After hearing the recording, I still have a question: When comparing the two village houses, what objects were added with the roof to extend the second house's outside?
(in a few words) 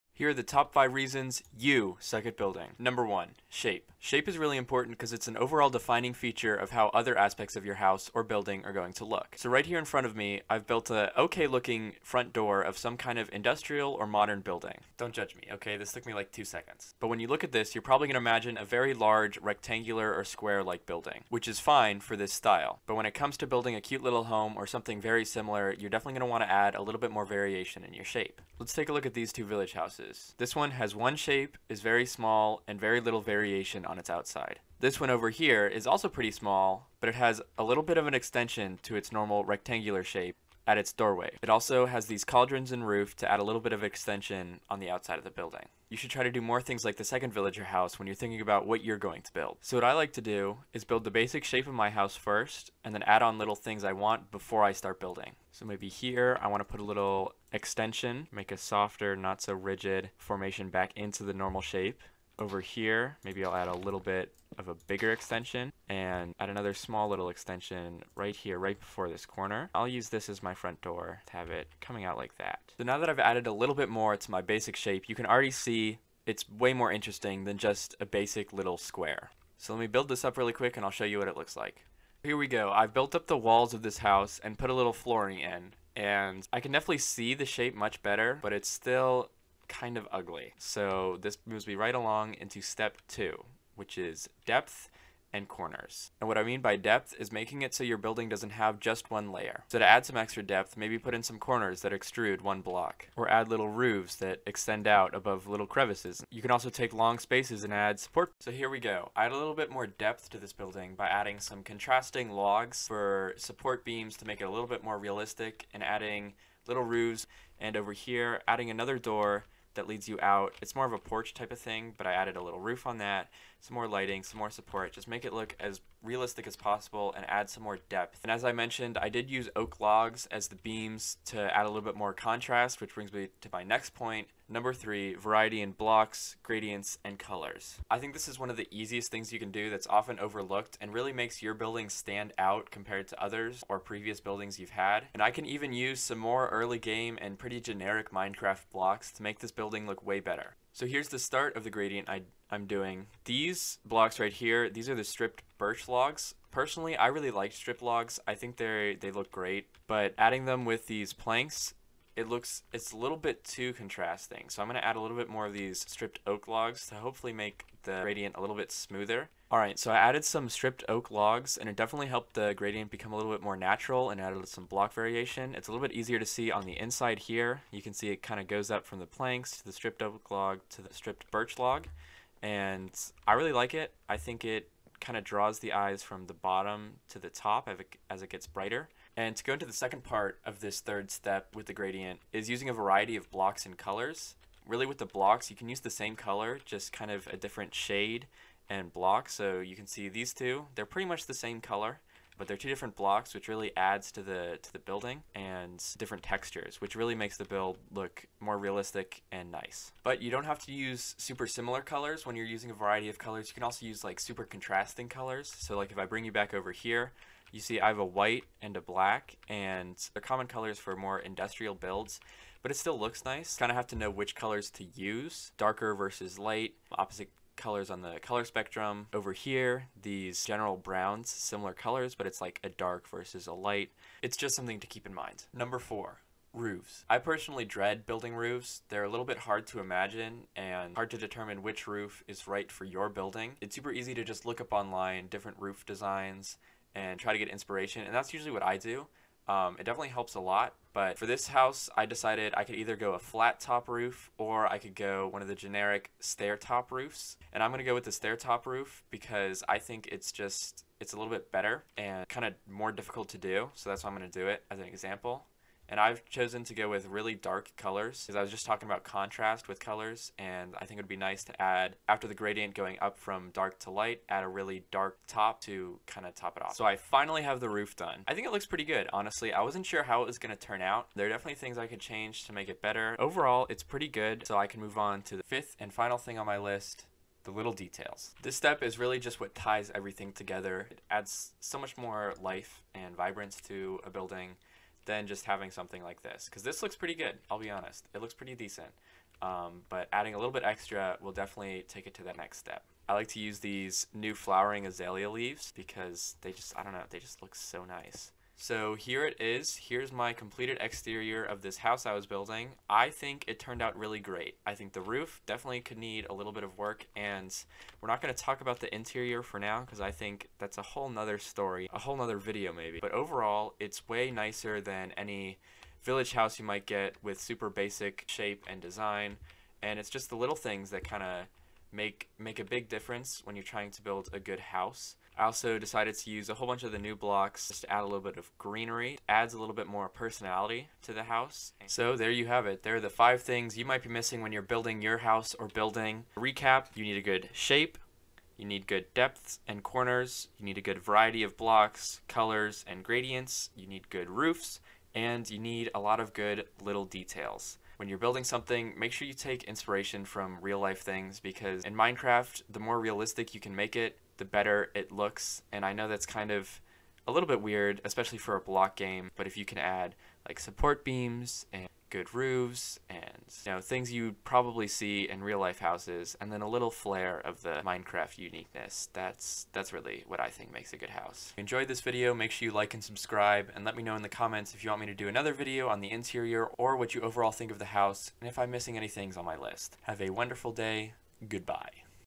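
Cauldrons.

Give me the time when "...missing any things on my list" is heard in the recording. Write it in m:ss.
6:28.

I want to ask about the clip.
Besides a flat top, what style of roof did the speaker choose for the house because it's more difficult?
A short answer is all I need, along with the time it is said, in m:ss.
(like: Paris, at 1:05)
Stair top roof, at 4:18.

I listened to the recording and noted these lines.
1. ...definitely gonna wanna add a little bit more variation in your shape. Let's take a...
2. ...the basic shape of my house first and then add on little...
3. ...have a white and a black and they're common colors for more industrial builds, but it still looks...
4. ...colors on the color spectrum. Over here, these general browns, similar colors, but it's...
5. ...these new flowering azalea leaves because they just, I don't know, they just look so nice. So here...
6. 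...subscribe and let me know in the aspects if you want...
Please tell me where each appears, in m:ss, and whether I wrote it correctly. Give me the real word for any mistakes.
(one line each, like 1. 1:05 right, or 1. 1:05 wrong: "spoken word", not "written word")
1. 0:25 right
2. 0:51 right
3. 3:37 right
4. 3:47 right
5. 5:03 right
6. 6:23 wrong: "comments", not "aspects".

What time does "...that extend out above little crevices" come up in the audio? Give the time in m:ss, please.
1:44.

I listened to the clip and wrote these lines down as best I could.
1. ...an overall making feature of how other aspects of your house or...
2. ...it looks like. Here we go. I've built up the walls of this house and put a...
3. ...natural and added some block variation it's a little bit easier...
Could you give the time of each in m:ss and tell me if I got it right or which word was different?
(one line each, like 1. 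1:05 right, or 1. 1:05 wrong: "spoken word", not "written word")
1. 0:05 wrong: "defining", not "making"
2. 1:21 right
3. 2:53 right.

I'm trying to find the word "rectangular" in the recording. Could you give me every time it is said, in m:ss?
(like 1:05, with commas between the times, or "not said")
0:19, 0:39.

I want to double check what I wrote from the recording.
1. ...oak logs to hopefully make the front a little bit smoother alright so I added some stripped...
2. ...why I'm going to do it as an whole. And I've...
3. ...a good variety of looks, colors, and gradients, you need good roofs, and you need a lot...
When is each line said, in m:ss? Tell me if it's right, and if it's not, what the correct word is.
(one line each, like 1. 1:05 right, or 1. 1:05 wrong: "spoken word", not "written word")
1. 2:46 wrong: "gradient", not "front"
2. 4:24 wrong: "example", not "whole"
3. 5:50 wrong: "blocks", not "looks".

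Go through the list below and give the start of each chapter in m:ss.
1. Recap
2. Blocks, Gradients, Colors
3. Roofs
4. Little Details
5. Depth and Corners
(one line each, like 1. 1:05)
1. 5:42
2. 2:16
3. 3:56
4. 4:46
5. 1:35.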